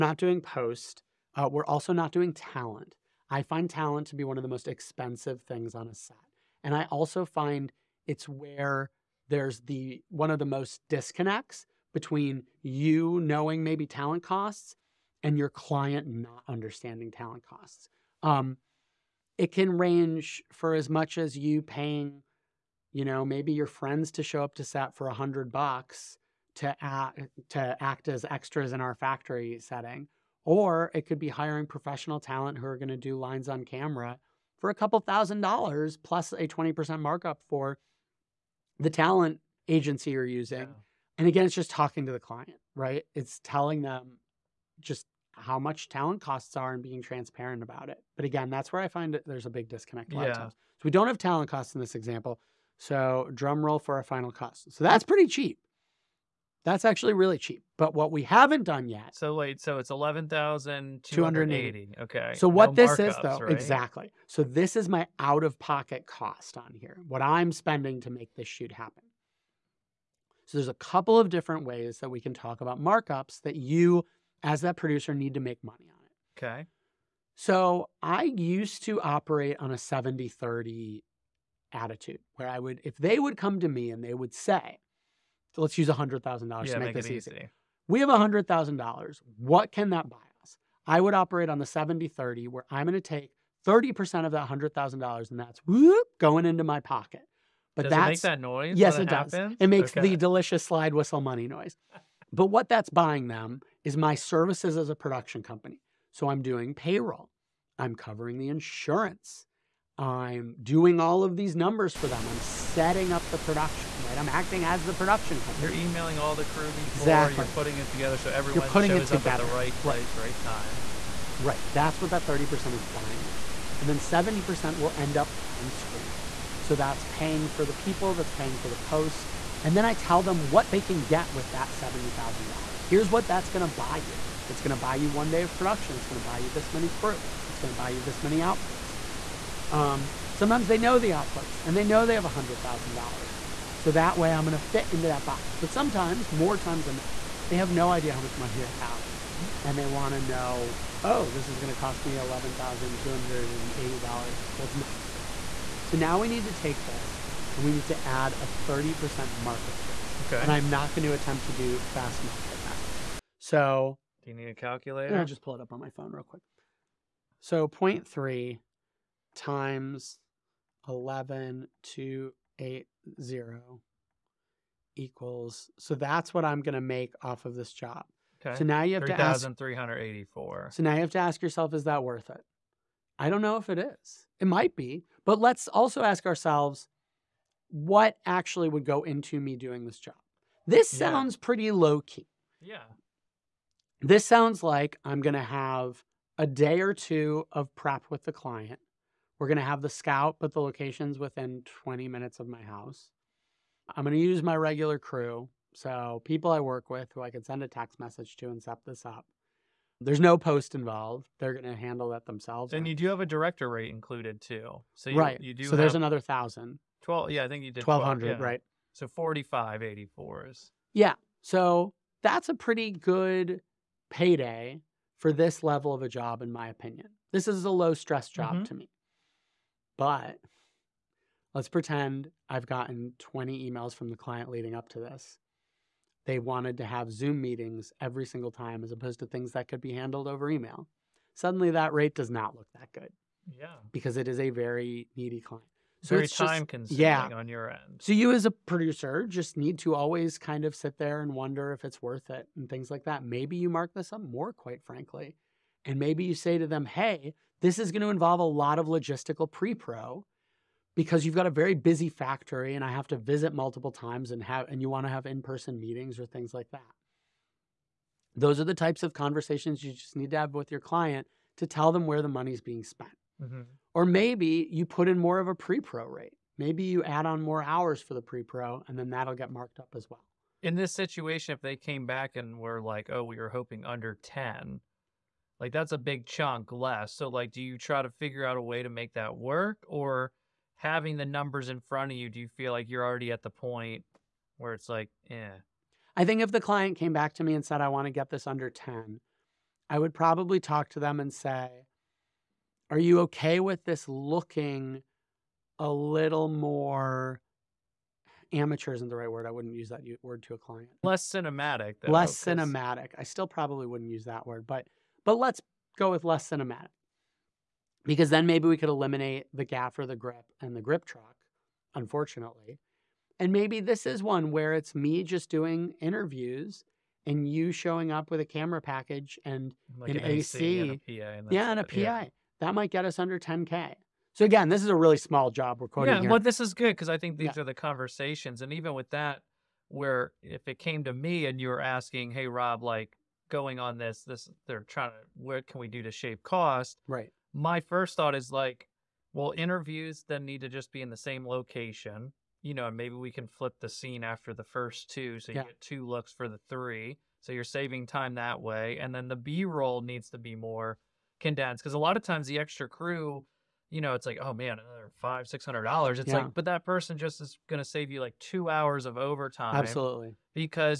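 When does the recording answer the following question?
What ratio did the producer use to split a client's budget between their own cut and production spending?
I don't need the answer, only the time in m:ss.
1:19.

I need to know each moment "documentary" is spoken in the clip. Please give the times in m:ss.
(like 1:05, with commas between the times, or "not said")
not said.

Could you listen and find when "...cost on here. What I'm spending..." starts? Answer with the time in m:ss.
1:06.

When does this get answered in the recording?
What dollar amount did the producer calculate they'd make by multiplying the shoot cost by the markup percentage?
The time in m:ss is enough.
2:59.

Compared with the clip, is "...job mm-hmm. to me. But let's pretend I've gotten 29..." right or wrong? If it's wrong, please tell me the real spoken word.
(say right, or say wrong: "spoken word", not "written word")
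wrong: "20", not "29".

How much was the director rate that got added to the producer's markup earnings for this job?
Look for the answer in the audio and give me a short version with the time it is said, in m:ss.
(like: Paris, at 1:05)
$1,200, at 3:37.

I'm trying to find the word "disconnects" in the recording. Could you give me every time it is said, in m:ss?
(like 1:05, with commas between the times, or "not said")
0:10, 0:49.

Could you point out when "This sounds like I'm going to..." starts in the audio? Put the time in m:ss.
3:13.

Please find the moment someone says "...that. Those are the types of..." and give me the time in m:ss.
4:26.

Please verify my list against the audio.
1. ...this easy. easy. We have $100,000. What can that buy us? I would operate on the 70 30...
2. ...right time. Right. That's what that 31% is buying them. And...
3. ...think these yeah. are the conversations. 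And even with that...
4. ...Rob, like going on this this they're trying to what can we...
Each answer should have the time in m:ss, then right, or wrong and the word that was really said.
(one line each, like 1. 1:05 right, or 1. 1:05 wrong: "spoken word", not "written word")
1. 1:26 right
2. 2:00 wrong: "30", not "31"
3. 5:37 right
4. 5:42 right.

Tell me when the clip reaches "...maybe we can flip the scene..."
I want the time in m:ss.
5:52.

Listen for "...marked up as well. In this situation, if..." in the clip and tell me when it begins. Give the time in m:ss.
4:39.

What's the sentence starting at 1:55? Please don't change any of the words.
You're emailing all the crew before exactly.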